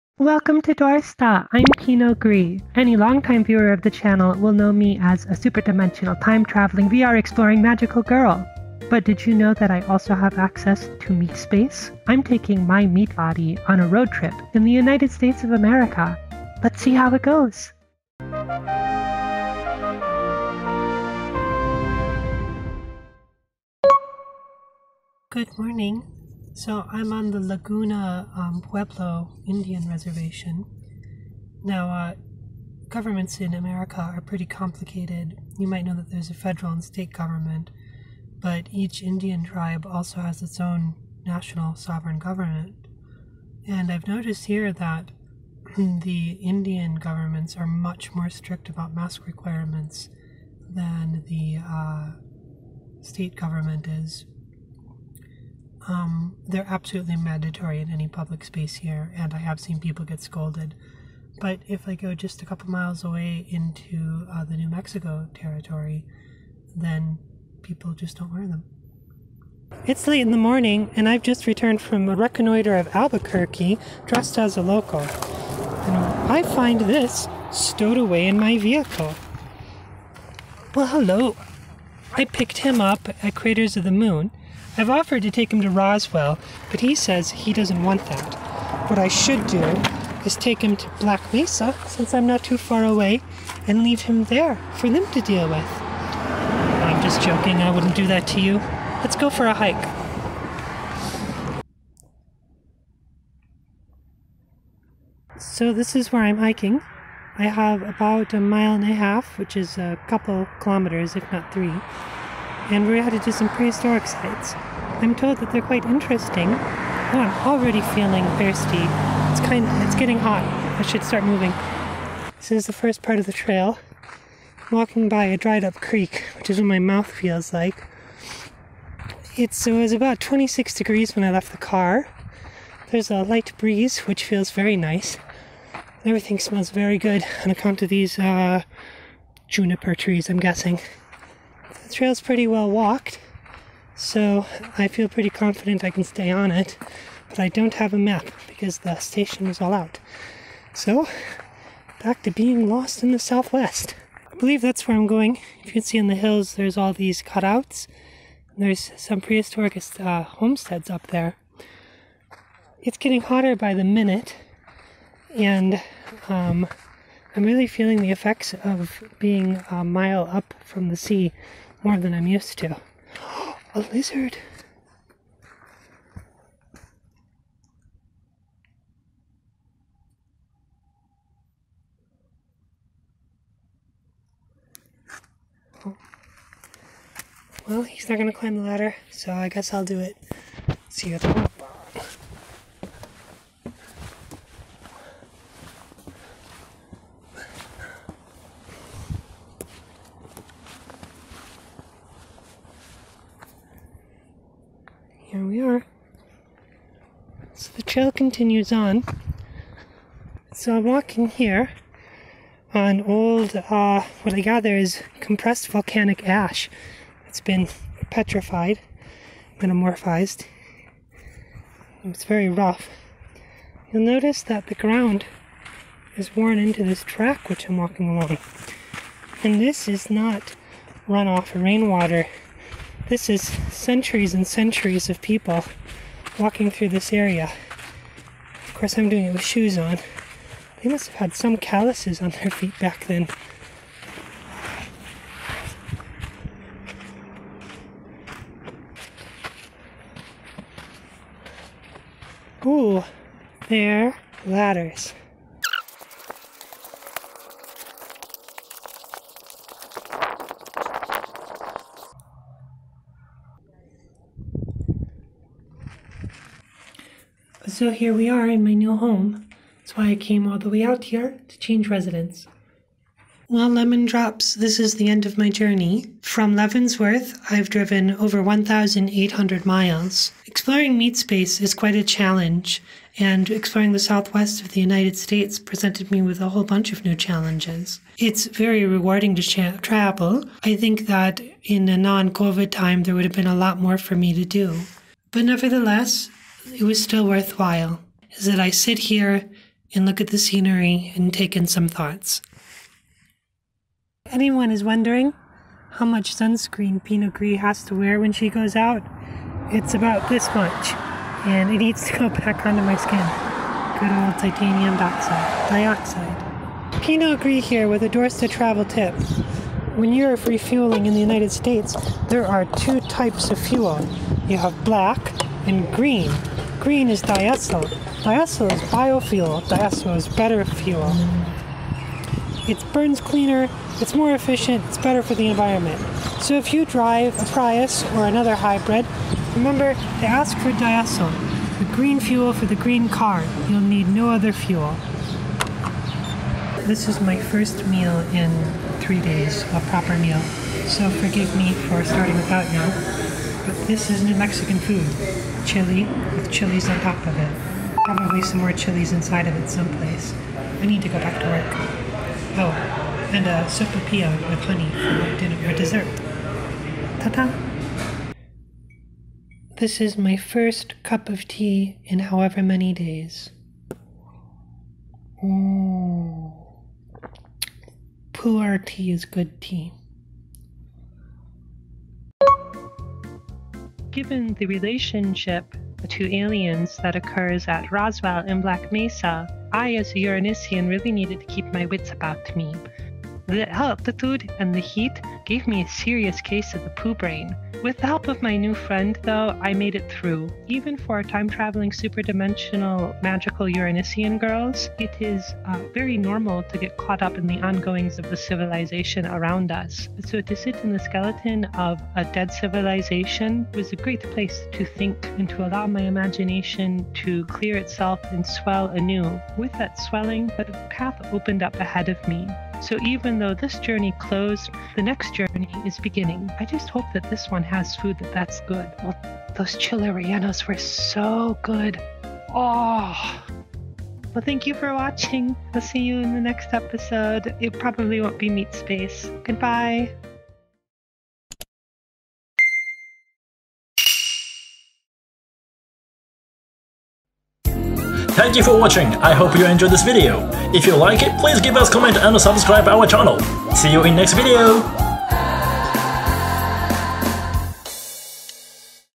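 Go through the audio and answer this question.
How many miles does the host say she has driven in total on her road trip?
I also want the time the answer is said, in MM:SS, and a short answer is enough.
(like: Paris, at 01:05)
1,800 miles, at 04:38.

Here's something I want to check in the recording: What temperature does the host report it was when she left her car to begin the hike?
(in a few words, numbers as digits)
26 degrees.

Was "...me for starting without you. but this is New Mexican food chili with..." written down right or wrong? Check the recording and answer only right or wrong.
right.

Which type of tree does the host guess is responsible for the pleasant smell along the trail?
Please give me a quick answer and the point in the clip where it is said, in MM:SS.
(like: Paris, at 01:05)
Juniper, at 02:19.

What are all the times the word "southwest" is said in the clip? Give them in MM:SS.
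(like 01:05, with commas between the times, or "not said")
02:33, 04:44.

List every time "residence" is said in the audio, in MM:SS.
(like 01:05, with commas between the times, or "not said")
04:31.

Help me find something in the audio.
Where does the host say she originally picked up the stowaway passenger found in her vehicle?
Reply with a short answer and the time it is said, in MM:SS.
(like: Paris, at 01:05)
Craters of the Moon, at 01:23.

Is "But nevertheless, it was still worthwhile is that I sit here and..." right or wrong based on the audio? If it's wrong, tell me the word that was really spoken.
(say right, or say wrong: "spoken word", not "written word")
right.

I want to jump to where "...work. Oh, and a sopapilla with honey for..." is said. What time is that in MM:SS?
06:01.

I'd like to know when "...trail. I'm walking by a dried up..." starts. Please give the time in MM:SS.
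02:03.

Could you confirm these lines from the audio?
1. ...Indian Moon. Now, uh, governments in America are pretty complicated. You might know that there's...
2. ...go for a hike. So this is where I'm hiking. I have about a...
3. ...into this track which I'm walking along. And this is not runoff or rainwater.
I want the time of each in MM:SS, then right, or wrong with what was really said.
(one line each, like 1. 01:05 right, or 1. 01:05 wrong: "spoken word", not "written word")
1. 00:29 wrong: "Reservation", not "Moon"
2. 01:39 right
3. 03:46 right.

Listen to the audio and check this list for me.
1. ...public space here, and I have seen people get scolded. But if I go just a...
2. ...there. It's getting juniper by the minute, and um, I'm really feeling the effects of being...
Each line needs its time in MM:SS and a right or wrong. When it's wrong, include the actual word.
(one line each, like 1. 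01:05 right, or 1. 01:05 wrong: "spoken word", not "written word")
1. 00:58 right
2. 02:41 wrong: "hotter", not "juniper".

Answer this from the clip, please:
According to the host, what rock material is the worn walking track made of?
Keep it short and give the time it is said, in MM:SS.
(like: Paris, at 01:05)
Compressed volcanic ash, at 03:35.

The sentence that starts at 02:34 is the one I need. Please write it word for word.
I believe that's where I'm going.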